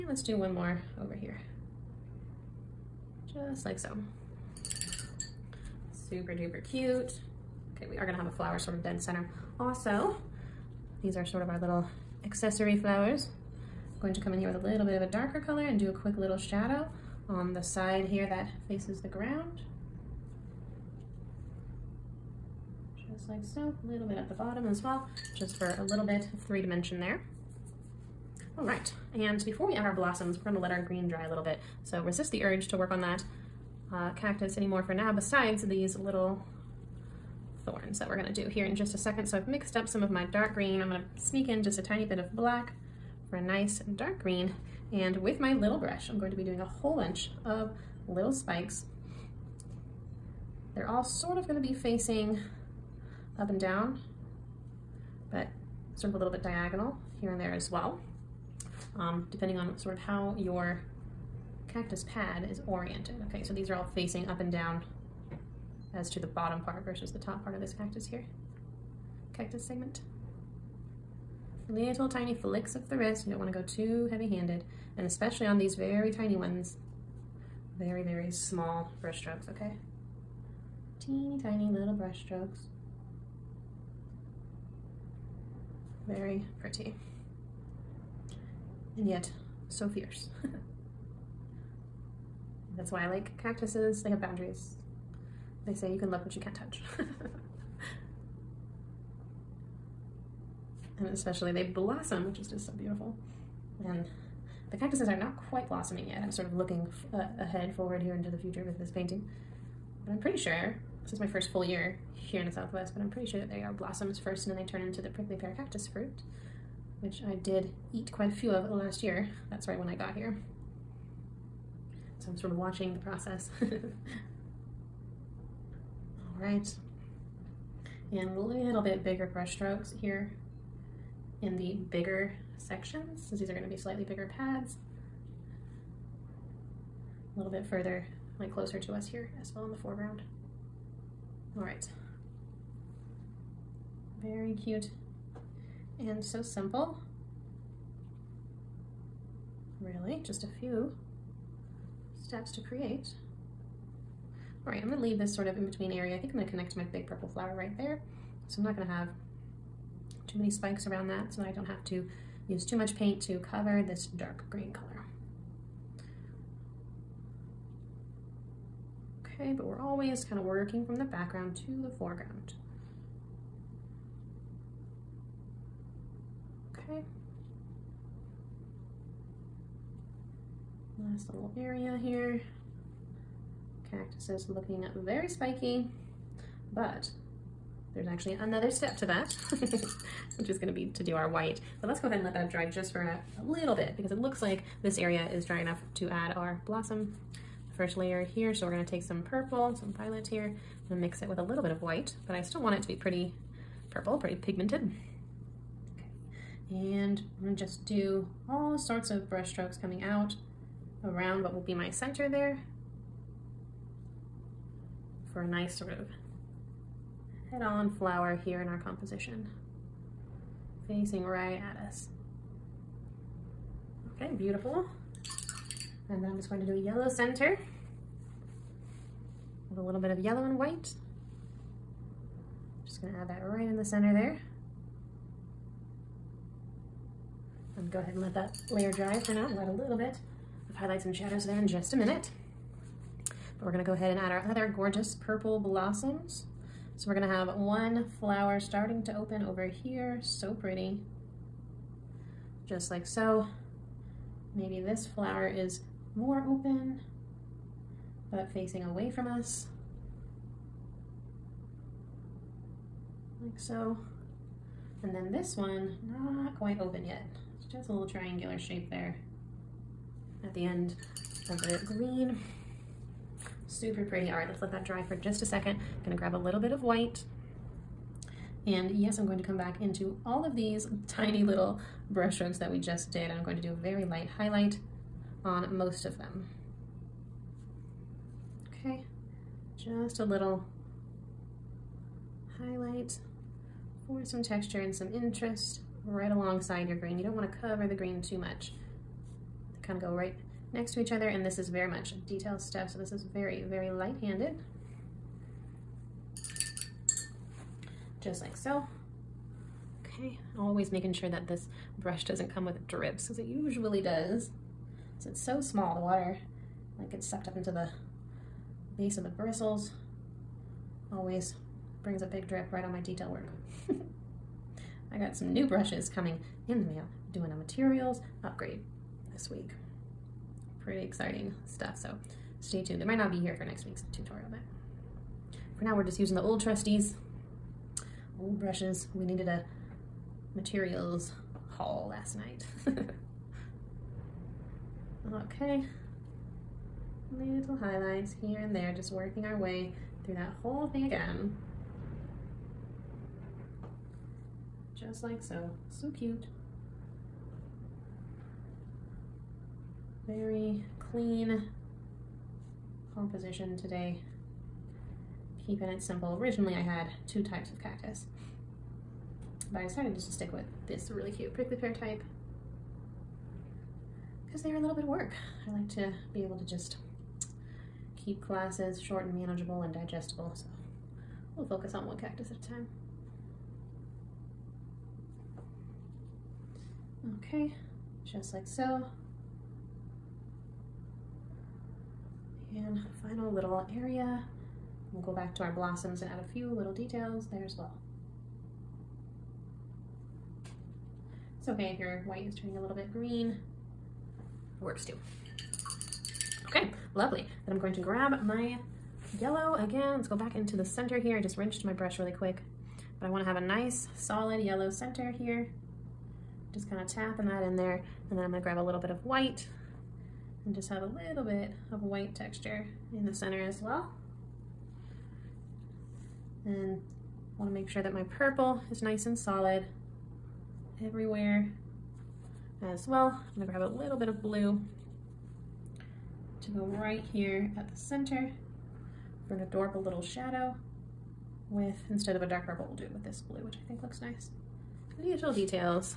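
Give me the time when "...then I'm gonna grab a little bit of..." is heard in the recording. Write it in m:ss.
6:58.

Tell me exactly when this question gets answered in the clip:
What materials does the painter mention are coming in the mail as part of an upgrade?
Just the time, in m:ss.
5:25.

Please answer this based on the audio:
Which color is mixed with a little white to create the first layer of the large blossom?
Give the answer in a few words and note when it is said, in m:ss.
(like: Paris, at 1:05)
Violet, at 3:19.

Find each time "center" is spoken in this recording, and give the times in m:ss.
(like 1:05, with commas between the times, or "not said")
0:09, 3:31, 3:47, 3:53, 6:50, 6:54, 7:03, 7:17.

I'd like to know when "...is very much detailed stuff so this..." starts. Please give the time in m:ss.
5:01.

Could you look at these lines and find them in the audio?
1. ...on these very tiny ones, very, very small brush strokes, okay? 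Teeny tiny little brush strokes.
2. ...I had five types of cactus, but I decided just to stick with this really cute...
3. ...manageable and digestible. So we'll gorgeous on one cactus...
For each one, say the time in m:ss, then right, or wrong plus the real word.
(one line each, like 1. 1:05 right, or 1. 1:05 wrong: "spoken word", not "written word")
1. 1:15 right
2. 6:06 wrong: "two", not "five"
3. 6:19 wrong: "focus", not "gorgeous".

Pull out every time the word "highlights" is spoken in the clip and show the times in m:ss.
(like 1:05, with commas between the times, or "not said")
4:00, 4:44, 4:52, 5:47.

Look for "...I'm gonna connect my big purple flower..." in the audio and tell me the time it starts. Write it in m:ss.
2:36.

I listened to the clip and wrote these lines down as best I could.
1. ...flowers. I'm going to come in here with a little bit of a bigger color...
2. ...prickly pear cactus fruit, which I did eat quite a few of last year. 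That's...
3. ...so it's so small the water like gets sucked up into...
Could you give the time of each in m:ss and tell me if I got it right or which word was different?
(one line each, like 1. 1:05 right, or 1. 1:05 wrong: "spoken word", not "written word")
1. 0:12 wrong: "darker", not "bigger"
2. 1:55 right
3. 5:15 right.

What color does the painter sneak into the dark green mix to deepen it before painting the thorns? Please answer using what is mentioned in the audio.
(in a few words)
Black.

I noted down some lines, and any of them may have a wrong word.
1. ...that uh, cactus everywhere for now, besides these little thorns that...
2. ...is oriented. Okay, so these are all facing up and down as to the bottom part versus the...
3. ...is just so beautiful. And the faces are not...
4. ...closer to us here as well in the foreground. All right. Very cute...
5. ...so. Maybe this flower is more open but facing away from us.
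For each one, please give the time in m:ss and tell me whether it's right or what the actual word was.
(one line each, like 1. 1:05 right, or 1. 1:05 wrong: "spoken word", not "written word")
1. 0:33 wrong: "anymore", not "everywhere"
2. 1:02 right
3. 1:42 wrong: "cactuses", not "faces"
4. 2:18 right
5. 4:13 right.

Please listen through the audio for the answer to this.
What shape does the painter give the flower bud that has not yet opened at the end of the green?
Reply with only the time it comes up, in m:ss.
4:28.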